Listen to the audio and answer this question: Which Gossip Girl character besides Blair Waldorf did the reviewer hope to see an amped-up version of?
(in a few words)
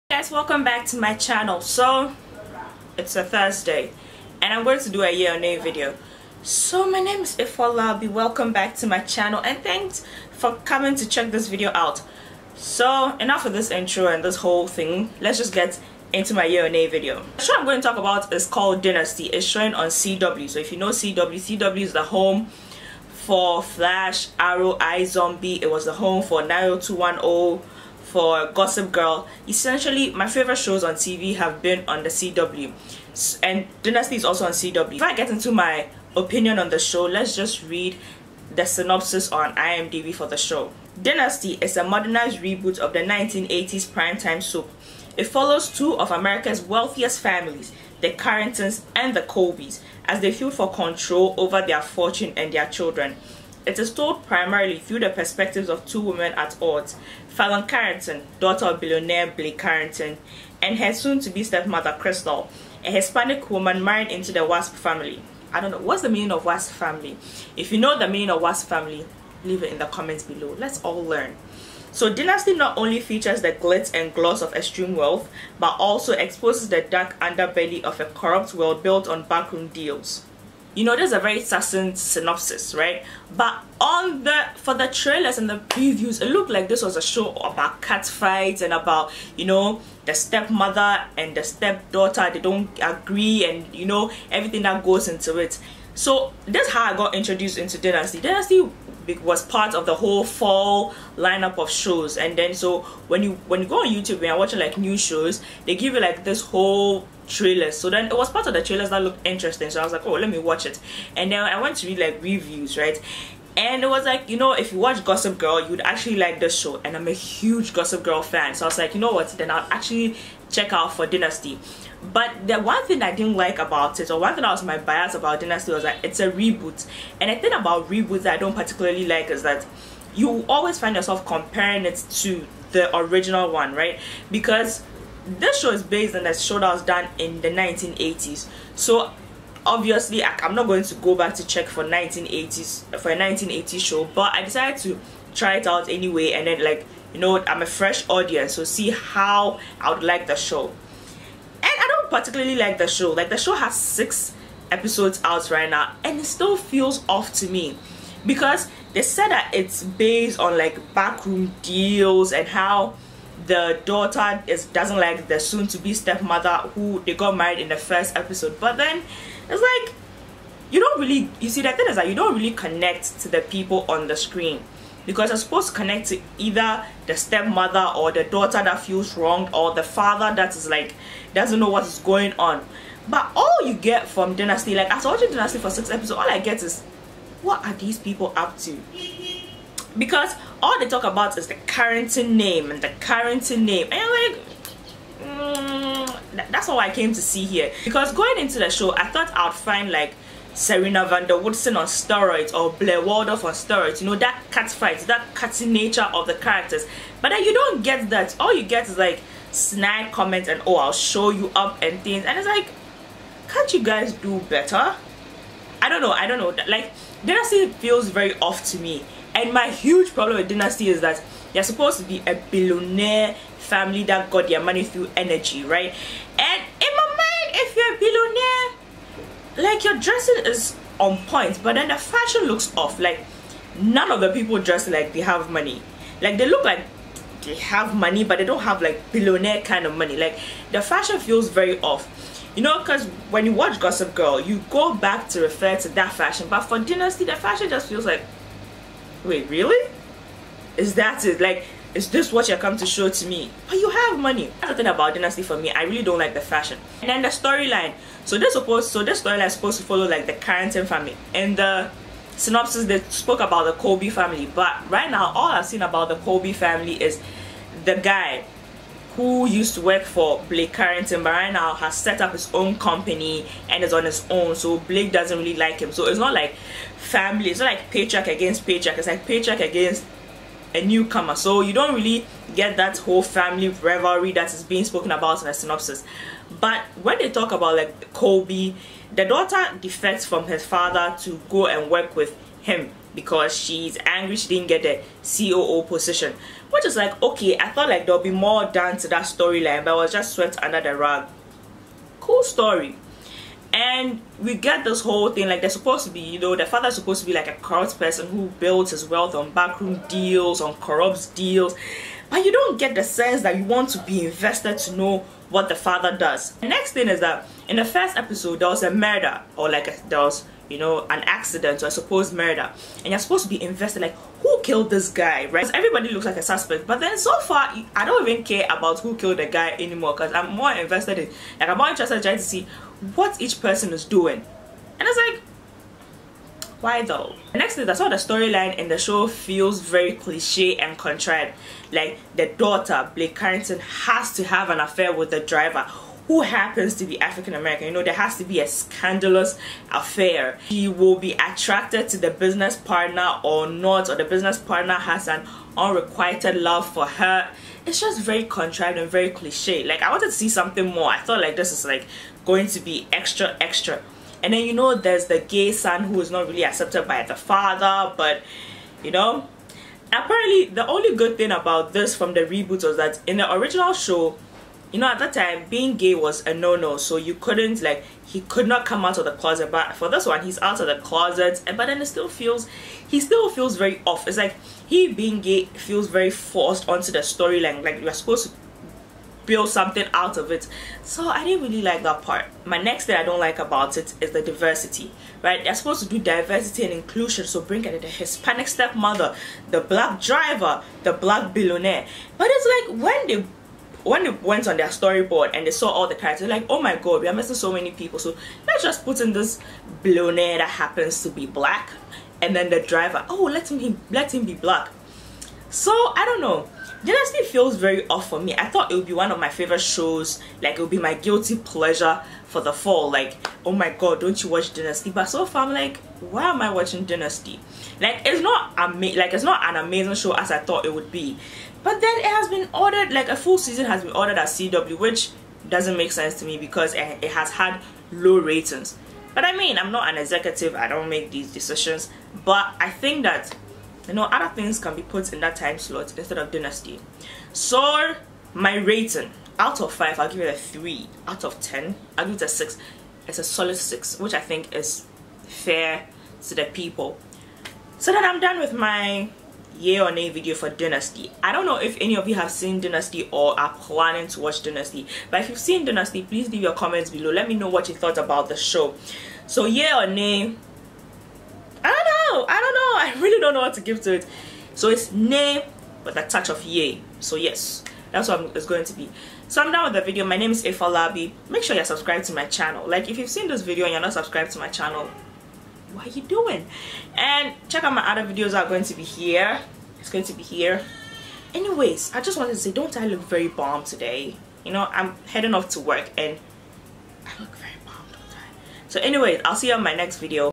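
Serena van der Woodsen.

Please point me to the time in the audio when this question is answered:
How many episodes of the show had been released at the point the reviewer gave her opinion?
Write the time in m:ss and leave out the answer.
2:33.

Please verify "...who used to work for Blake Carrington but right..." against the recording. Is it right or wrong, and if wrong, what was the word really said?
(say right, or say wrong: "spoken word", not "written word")
right.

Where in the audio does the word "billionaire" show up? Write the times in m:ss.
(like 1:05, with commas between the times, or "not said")
0:58, 3:42, 3:49, 3:59, 6:41.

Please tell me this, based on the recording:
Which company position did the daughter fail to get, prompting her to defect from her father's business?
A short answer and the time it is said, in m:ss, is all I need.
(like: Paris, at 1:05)
COO, at 4:55.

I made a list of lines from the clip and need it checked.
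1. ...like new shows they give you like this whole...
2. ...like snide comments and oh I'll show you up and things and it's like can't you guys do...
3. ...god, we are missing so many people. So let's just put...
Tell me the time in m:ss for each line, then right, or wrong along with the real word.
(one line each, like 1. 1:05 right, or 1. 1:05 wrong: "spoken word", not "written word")
1. 1:44 right
2. 3:28 right
3. 6:46 right.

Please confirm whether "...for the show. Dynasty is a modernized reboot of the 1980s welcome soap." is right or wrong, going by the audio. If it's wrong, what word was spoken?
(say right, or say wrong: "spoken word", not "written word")
wrong: "primetime", not "welcome".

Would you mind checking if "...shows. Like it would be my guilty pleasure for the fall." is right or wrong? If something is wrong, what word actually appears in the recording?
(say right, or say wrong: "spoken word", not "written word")
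right.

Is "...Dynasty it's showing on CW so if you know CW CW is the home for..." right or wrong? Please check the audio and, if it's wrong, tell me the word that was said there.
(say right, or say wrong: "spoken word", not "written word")
right.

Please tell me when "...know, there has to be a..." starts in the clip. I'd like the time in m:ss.
5:47.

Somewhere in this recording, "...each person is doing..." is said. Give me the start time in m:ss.
5:33.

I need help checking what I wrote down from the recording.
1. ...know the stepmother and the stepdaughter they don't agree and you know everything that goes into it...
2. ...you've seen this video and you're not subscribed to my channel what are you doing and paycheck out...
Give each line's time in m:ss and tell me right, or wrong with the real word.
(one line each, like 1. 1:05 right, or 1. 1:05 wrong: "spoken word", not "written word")
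1. 1:29 right
2. 8:03 wrong: "check", not "paycheck".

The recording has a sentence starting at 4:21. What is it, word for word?
And the synopsis they spoke about the Colby family.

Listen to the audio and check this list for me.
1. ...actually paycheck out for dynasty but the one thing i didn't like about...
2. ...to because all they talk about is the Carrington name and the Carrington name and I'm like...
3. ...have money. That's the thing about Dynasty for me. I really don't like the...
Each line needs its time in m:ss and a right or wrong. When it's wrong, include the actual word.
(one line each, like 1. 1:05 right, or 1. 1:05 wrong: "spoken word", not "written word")
1. 1:59 wrong: "check", not "paycheck"
2. 3:08 right
3. 4:13 right.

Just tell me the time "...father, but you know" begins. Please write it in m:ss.
6:07.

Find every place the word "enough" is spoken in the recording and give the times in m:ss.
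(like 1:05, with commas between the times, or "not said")
0:13.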